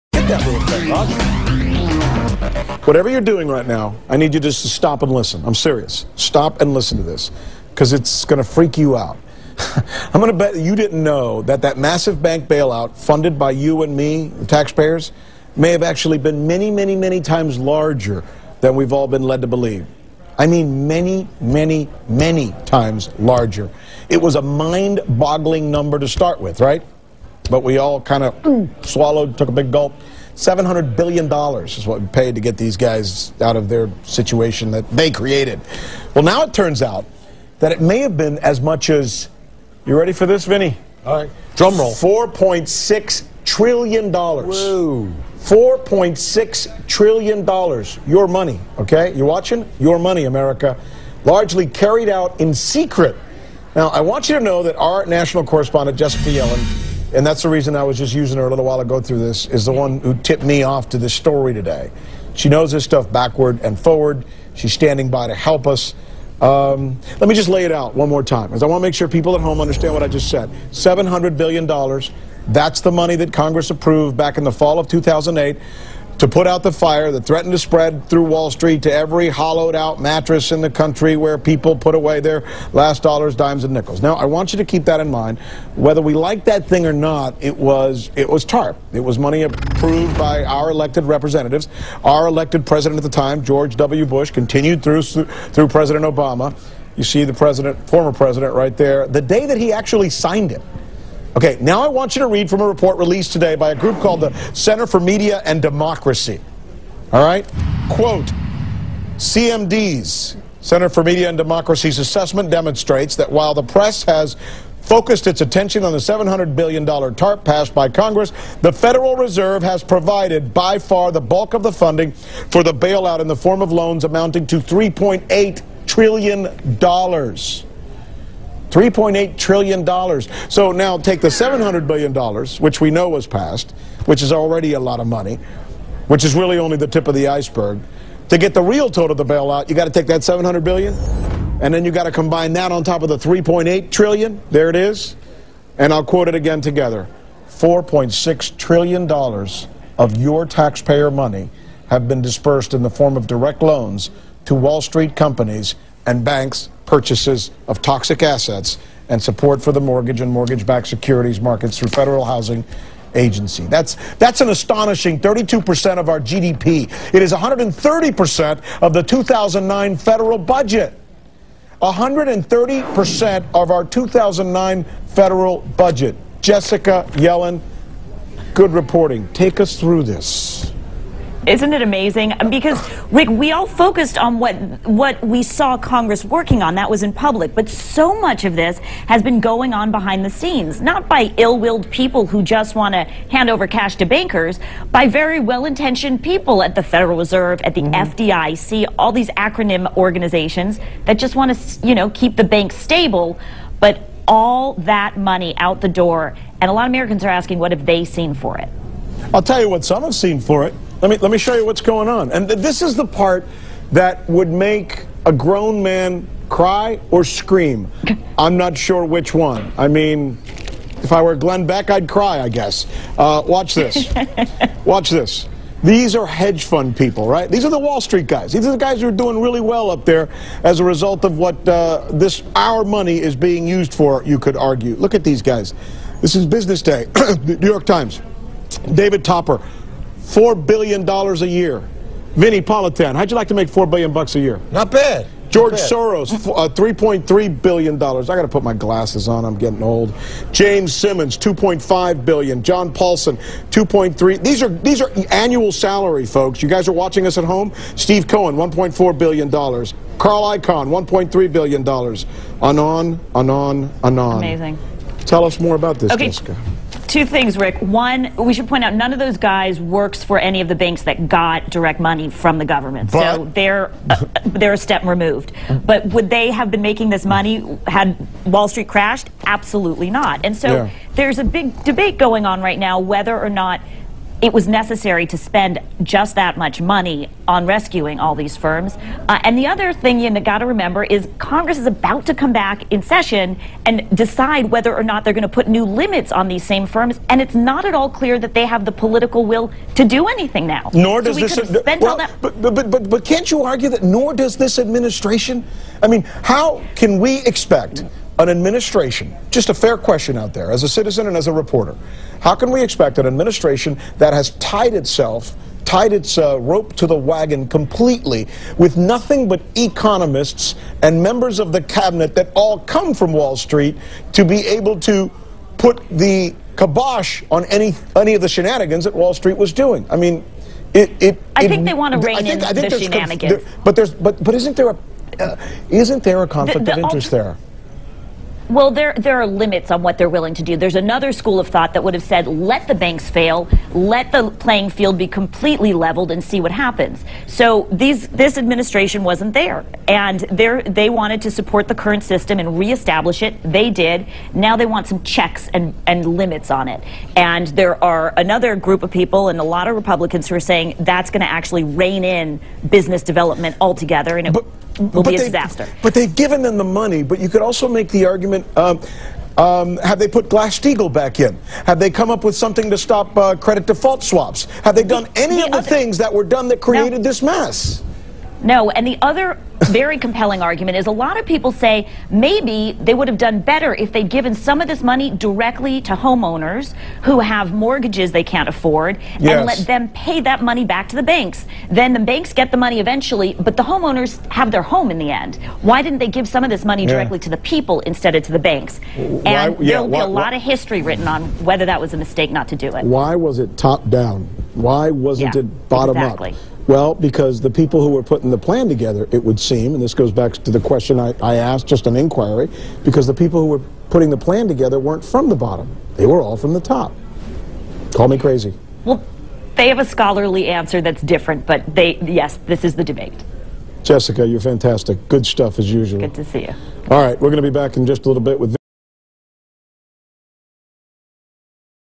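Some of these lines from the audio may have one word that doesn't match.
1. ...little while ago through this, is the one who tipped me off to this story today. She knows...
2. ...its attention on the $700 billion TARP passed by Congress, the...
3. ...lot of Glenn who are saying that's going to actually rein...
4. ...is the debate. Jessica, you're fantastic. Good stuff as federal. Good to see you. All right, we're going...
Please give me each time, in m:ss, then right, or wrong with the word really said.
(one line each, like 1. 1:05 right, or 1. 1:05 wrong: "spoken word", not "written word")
1. 0:58 right
2. 1:55 right
3. 5:59 wrong: "Republicans", not "Glenn"
4. 7:02 wrong: "usual", not "federal".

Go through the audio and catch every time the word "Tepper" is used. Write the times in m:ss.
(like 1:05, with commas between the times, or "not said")
3:59.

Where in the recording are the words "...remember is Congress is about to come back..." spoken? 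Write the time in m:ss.
4:50.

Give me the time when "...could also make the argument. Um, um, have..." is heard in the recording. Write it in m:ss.
6:07.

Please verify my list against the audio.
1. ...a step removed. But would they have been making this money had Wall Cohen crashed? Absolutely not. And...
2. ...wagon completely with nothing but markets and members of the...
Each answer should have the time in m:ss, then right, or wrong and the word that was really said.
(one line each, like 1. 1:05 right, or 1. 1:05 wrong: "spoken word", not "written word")
1. 4:34 wrong: "Street", not "Cohen"
2. 5:17 wrong: "economists", not "markets".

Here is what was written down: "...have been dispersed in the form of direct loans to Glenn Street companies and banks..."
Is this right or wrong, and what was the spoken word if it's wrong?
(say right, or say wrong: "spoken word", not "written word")
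wrong: "Wall", not "Glenn".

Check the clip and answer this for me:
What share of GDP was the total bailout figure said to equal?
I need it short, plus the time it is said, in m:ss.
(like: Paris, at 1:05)
32%, at 2:45.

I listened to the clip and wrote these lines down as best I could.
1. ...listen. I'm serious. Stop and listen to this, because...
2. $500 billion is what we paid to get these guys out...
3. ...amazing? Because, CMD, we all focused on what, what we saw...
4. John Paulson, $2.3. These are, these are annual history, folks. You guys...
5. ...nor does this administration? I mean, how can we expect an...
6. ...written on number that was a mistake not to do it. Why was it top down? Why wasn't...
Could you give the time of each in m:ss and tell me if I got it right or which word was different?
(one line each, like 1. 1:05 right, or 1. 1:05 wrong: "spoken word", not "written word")
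1. 0:05 right
2. 0:30 wrong: "700", not "500"
3. 3:01 wrong: "Rick", not "CMD"
4. 4:12 wrong: "salary", not "history"
5. 5:04 right
6. 6:41 wrong: "whether", not "number".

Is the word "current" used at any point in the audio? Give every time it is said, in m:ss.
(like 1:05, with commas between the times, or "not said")
5:51.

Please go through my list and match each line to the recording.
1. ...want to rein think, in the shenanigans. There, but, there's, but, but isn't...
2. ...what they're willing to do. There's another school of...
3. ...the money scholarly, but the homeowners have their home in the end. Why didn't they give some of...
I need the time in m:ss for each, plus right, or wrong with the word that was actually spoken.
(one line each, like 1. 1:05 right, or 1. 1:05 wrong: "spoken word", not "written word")
1. 5:31 right
2. 5:40 right
3. 6:32 wrong: "eventually", not "scholarly".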